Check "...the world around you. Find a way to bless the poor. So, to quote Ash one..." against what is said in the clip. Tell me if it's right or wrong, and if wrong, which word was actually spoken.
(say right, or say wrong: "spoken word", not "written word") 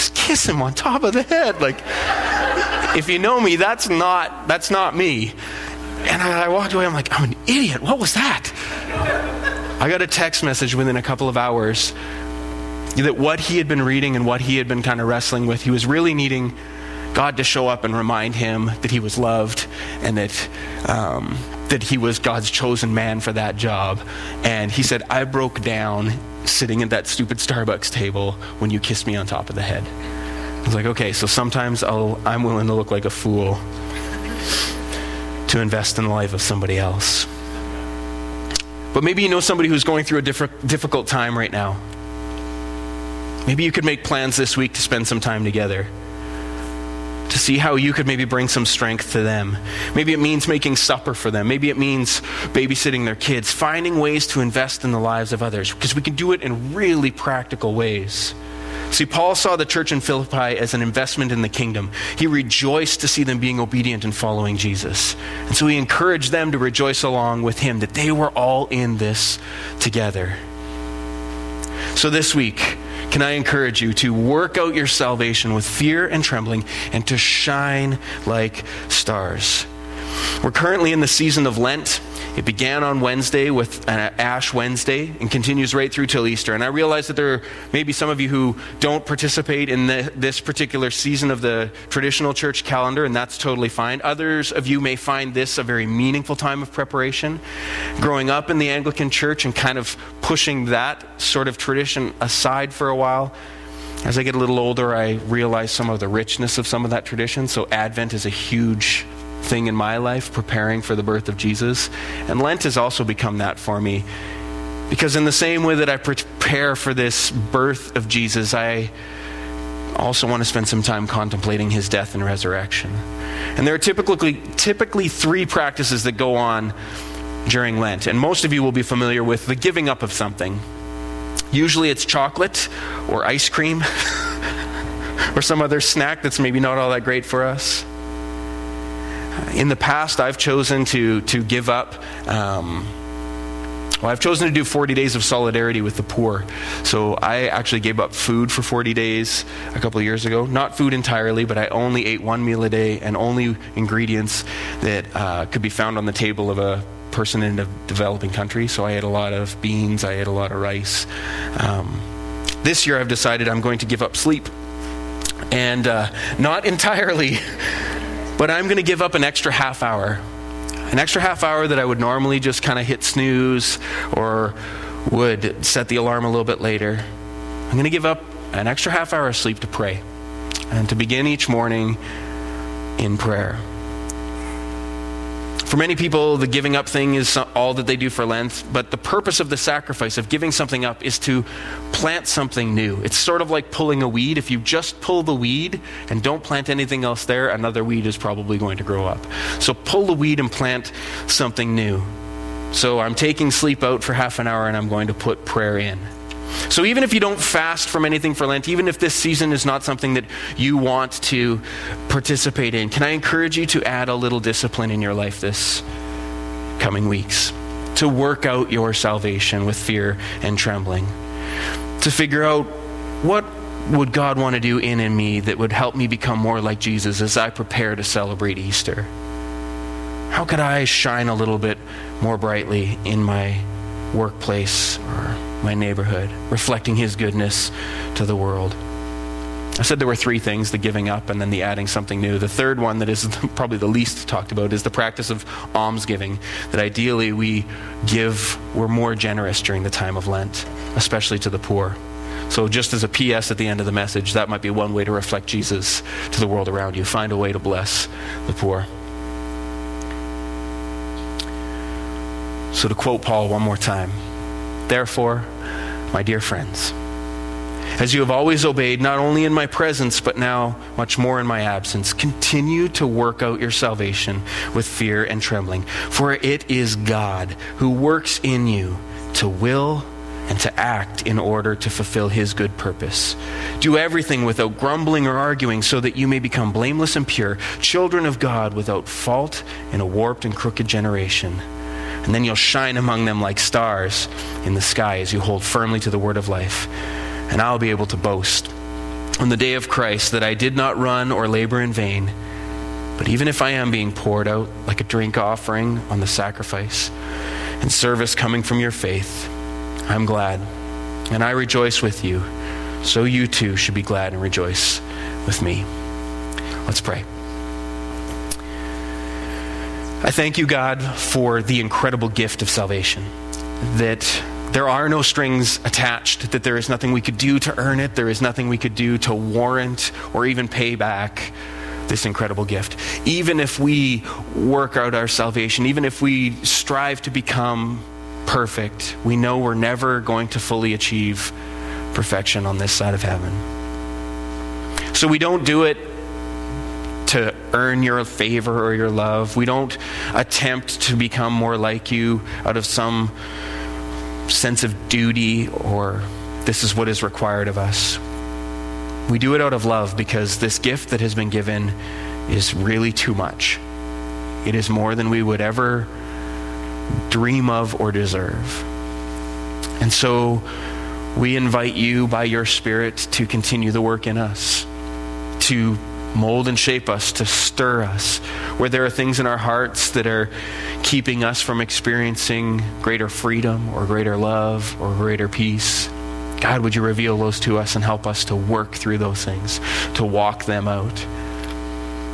wrong: "Paul", not "Ash".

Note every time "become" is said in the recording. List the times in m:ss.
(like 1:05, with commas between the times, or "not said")
1:53, 3:46, 4:46, 5:37, 5:51.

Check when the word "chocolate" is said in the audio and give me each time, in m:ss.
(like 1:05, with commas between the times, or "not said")
2:12.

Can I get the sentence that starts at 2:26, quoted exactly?
So I actually gave up food for 40 days a couple of years ago.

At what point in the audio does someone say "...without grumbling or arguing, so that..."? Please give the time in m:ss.
4:44.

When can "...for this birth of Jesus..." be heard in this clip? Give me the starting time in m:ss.
1:56.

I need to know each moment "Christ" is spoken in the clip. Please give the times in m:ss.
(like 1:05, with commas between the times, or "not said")
4:59.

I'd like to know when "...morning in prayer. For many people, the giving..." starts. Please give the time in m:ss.
3:01.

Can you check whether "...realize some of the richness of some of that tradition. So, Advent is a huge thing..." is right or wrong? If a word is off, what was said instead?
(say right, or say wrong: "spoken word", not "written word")
right.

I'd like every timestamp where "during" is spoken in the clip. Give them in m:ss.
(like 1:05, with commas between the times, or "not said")
2:07, 4:09.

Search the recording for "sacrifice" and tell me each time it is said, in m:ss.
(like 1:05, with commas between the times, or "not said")
3:09, 5:06.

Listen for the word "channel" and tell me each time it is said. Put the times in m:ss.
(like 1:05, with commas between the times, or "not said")
not said.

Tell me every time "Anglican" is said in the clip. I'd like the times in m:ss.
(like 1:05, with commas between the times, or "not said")
1:38.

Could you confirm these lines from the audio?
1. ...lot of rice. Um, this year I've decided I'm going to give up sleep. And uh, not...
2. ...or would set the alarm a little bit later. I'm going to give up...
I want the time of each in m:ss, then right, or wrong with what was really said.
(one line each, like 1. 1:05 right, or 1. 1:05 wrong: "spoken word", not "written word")
1. 2:40 right
2. 2:54 right.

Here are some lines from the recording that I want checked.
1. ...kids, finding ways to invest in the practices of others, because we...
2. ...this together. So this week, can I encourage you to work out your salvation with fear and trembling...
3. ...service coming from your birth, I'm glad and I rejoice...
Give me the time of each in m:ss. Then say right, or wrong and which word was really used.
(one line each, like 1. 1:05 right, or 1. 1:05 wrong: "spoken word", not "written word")
1. 0:53 wrong: "lives", not "practices"
2. 1:08 right
3. 5:07 wrong: "faith", not "birth".